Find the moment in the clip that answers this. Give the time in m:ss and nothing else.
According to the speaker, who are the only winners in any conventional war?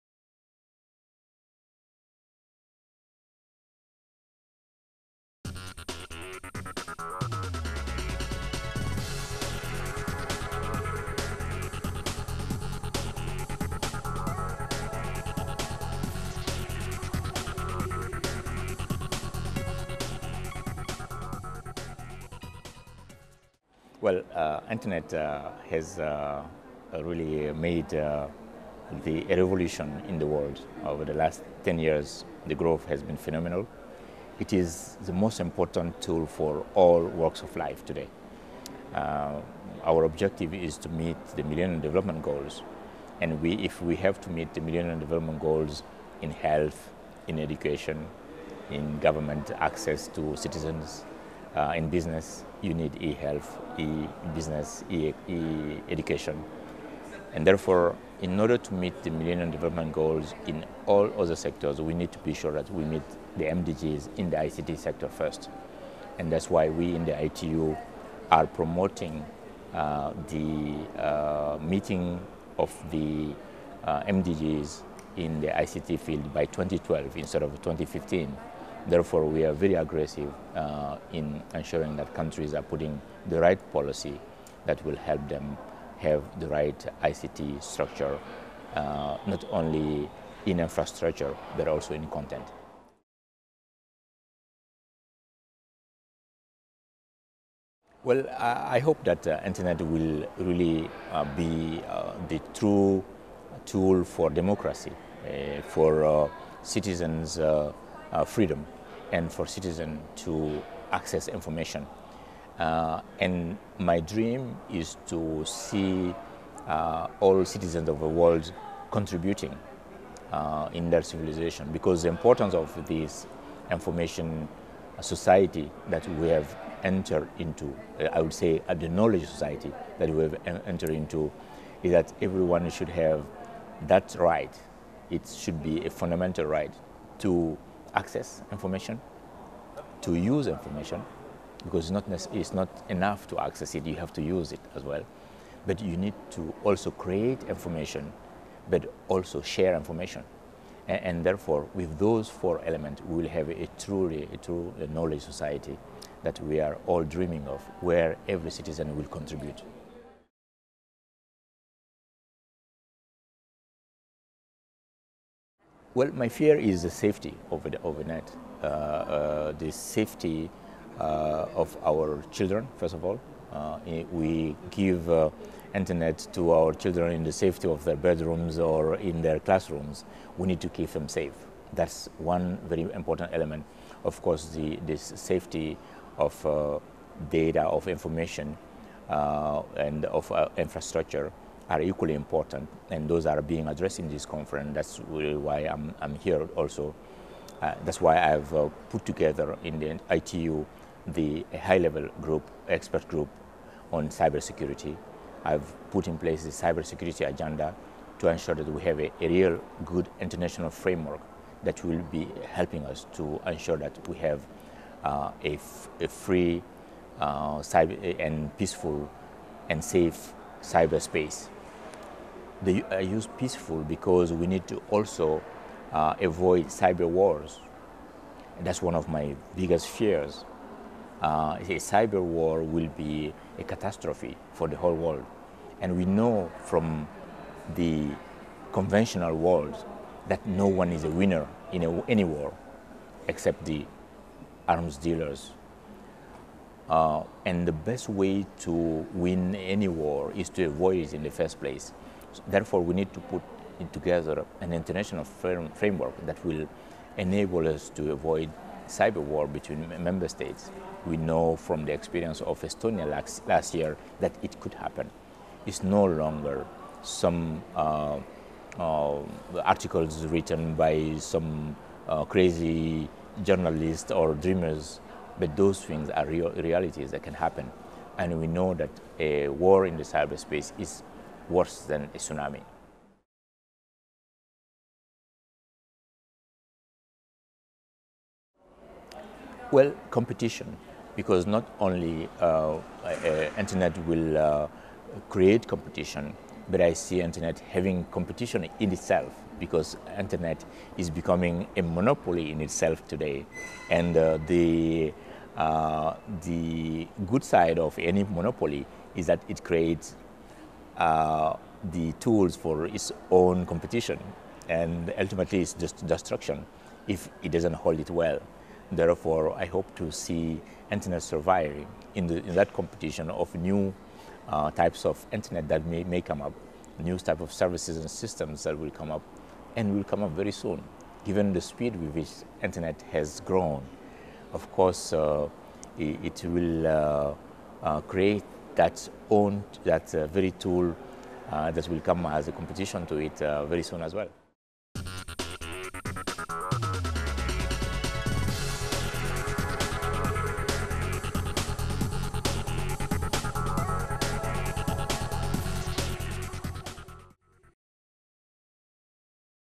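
4:03.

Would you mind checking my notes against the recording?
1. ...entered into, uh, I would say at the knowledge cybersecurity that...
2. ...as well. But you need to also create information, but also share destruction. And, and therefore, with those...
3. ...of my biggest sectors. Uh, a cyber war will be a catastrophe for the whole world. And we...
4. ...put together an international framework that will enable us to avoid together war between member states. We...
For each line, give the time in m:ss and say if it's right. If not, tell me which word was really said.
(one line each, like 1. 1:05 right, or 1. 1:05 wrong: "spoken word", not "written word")
1. 2:06 wrong: "society", not "cybersecurity"
2. 2:24 wrong: "information", not "destruction"
3. 3:48 wrong: "fears", not "sectors"
4. 4:13 wrong: "cyber", not "together".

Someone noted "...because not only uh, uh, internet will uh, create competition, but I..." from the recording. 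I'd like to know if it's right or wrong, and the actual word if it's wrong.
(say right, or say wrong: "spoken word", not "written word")
right.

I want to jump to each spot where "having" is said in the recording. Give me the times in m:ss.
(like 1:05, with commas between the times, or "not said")
4:57.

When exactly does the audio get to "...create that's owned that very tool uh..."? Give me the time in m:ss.
5:38.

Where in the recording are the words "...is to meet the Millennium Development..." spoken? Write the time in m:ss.
0:40.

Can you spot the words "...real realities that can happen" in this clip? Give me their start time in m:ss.
4:36.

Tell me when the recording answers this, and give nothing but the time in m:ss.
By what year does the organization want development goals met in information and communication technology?
1:16.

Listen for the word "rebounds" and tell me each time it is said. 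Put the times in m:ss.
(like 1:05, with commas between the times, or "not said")
not said.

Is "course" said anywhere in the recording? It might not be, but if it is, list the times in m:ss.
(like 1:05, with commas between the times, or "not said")
3:04, 5:34.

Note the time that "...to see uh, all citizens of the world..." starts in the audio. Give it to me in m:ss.
1:55.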